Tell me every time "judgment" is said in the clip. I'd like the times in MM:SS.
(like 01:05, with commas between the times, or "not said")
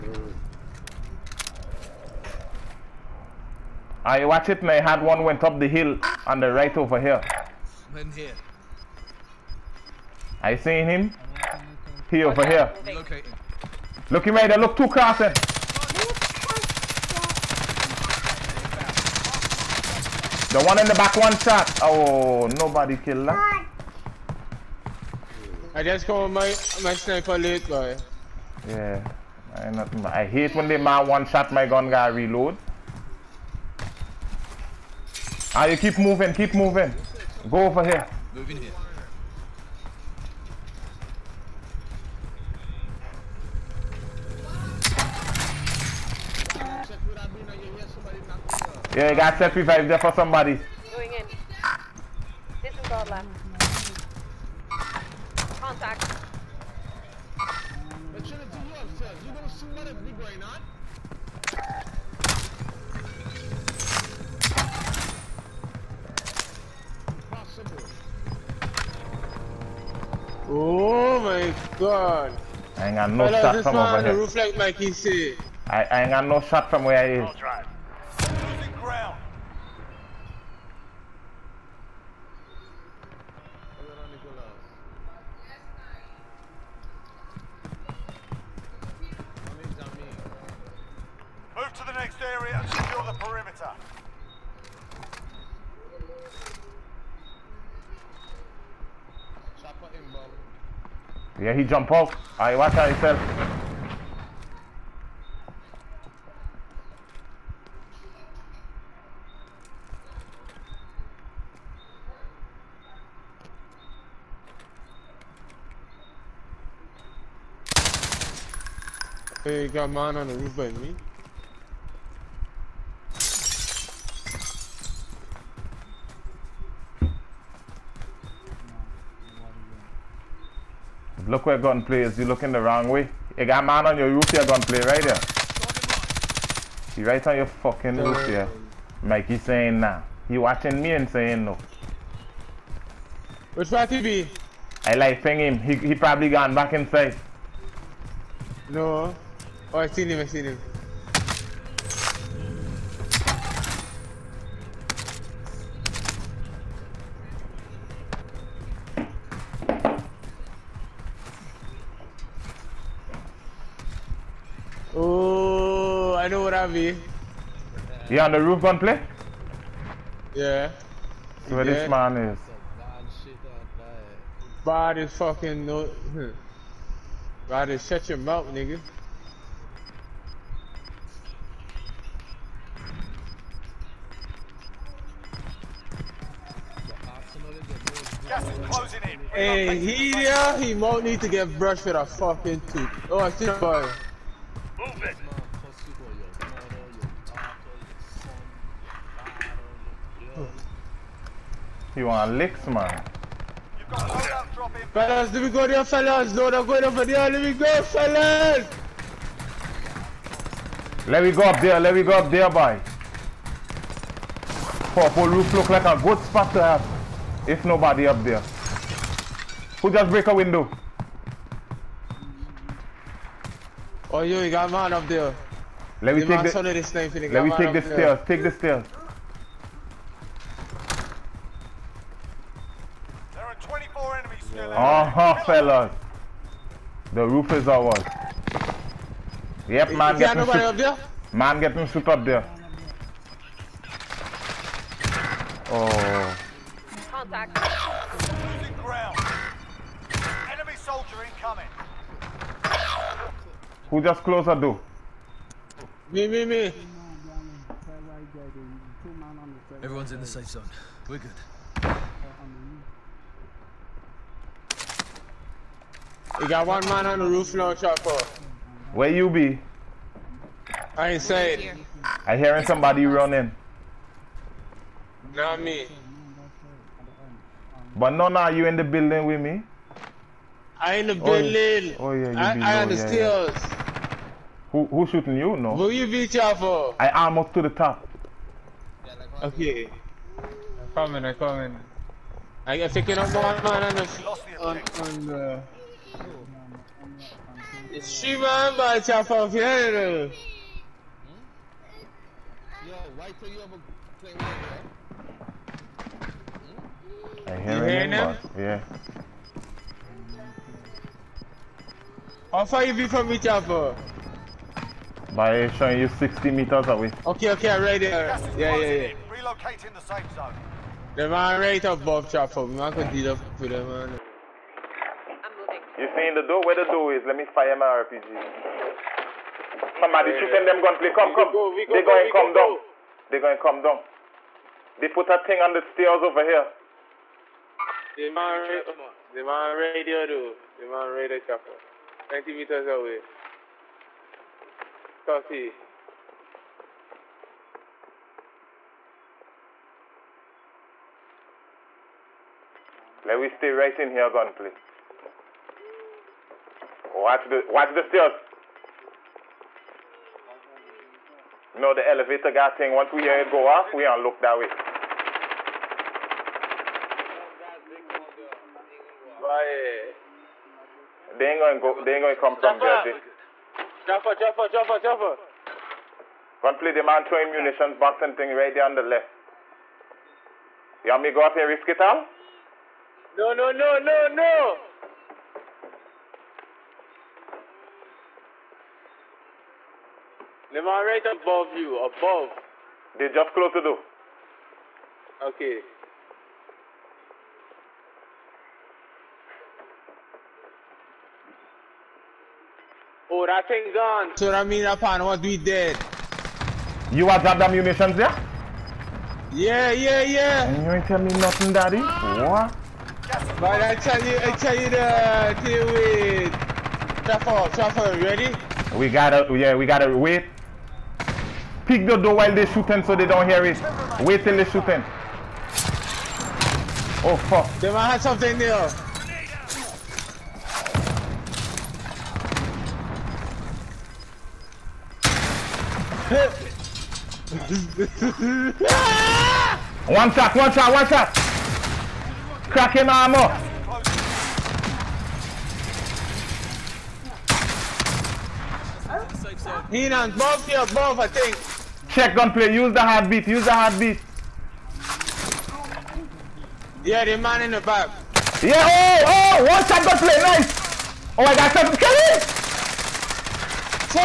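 not said.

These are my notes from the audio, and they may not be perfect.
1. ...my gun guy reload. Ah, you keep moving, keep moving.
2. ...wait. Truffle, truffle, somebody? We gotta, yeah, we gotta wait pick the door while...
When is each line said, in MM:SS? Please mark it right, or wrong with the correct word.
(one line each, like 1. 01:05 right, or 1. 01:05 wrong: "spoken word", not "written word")
1. 00:31 right
2. 06:55 wrong: "ready", not "somebody".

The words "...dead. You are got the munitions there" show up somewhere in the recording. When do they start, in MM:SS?
06:45.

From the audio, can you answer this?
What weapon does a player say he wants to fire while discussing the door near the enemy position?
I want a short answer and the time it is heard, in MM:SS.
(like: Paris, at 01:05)
RPG, at 05:27.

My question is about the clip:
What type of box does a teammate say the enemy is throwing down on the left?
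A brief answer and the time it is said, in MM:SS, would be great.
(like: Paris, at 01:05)
Munitions box, at 06:17.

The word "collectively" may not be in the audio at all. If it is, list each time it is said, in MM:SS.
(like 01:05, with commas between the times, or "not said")
not said.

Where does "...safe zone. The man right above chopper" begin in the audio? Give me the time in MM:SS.
05:20.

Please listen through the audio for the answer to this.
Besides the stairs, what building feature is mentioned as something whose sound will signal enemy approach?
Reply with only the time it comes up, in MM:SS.
06:02.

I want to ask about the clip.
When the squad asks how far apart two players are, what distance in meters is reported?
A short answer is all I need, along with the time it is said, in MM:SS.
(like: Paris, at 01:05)
60 meters, at 05:16.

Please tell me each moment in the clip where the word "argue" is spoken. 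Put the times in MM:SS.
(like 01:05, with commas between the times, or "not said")
not said.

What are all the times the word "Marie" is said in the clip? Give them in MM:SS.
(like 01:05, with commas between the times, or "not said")
not said.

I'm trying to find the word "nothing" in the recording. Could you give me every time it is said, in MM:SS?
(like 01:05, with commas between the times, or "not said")
06:51.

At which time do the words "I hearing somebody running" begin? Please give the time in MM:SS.
04:32.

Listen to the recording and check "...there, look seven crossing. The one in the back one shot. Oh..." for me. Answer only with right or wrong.
wrong.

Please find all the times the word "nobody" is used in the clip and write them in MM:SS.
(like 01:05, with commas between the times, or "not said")
00:22, 03:37, 04:00.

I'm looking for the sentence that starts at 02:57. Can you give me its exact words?
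Bad is shut your mouth, nigga.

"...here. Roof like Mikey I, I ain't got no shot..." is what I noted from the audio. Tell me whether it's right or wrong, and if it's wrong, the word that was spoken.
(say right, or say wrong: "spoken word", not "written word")
right.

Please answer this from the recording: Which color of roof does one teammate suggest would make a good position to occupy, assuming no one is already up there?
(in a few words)
Purple.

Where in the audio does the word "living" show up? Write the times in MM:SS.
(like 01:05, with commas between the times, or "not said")
not said.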